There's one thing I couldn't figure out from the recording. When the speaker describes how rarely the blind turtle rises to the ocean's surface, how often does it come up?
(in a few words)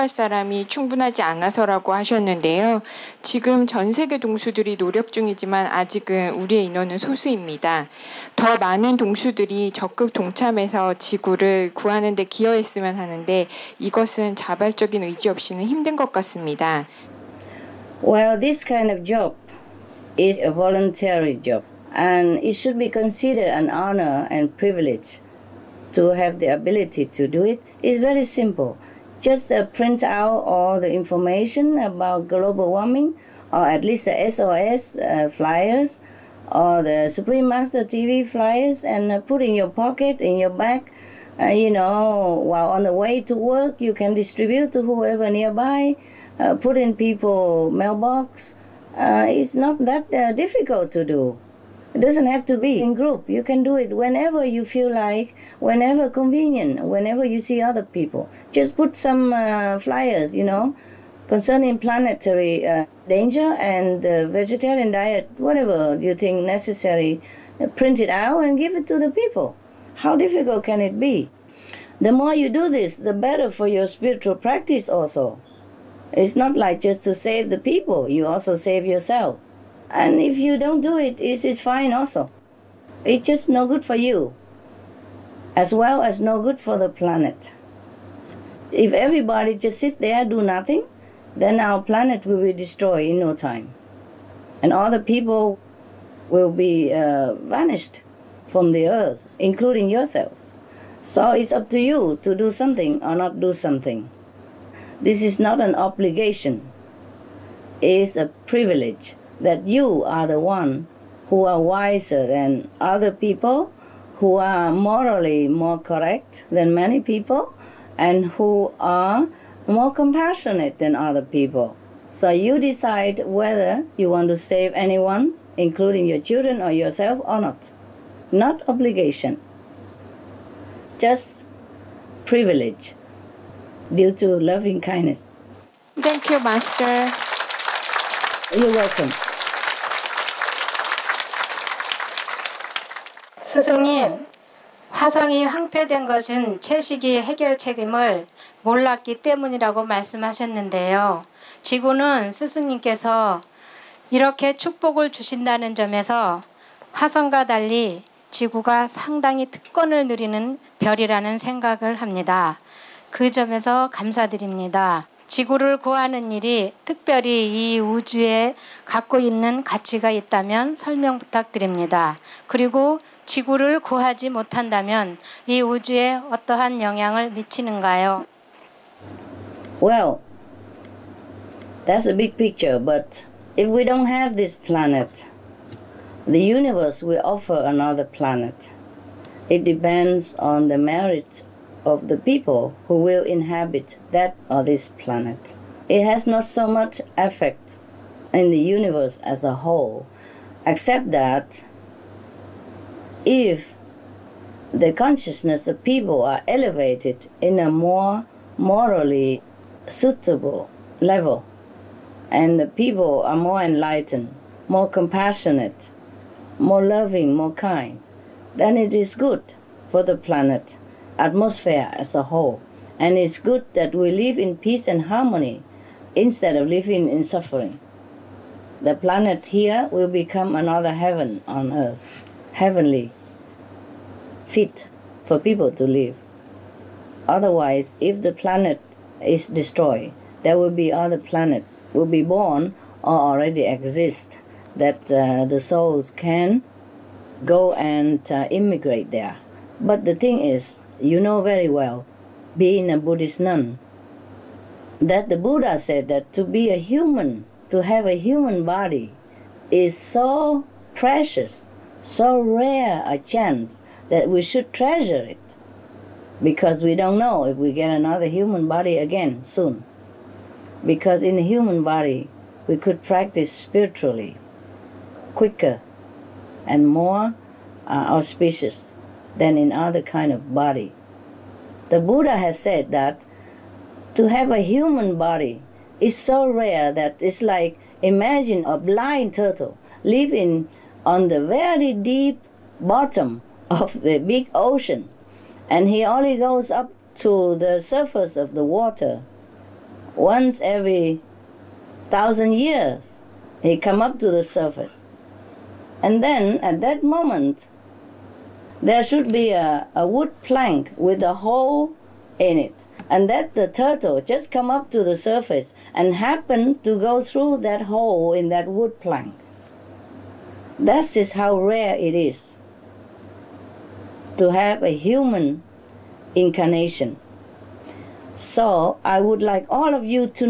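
once every thousand years.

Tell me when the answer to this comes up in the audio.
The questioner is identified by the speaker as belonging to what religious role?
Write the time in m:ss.
4:12.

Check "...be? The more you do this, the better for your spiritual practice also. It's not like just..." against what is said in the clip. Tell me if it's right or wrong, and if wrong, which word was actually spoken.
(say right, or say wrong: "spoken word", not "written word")
right.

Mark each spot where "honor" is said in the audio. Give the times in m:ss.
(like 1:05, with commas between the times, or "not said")
0:23.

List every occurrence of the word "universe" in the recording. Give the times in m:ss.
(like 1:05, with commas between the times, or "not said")
3:06, 3:18.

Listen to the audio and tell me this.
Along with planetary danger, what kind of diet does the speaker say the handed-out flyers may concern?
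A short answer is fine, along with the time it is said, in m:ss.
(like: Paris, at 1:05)
vegetarian diet, at 1:04.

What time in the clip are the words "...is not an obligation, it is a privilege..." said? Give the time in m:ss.
1:45.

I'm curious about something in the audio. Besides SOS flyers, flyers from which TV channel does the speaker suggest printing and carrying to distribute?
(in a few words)
Supreme Master TV.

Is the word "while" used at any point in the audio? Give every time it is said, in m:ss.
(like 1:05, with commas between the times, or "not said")
0:42.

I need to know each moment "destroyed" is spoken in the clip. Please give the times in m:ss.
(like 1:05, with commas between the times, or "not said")
1:32, 3:59.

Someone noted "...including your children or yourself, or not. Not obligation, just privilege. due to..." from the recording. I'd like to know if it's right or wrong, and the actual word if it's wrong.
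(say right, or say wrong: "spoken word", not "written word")
right.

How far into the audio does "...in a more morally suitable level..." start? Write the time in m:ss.
3:27.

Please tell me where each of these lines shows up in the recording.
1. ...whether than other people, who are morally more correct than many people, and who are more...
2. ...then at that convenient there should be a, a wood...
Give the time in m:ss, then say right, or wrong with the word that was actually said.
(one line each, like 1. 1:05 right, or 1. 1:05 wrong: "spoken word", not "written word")
1. 1:51 wrong: "wiser", not "whether"
2. 5:06 wrong: "moment", not "convenient".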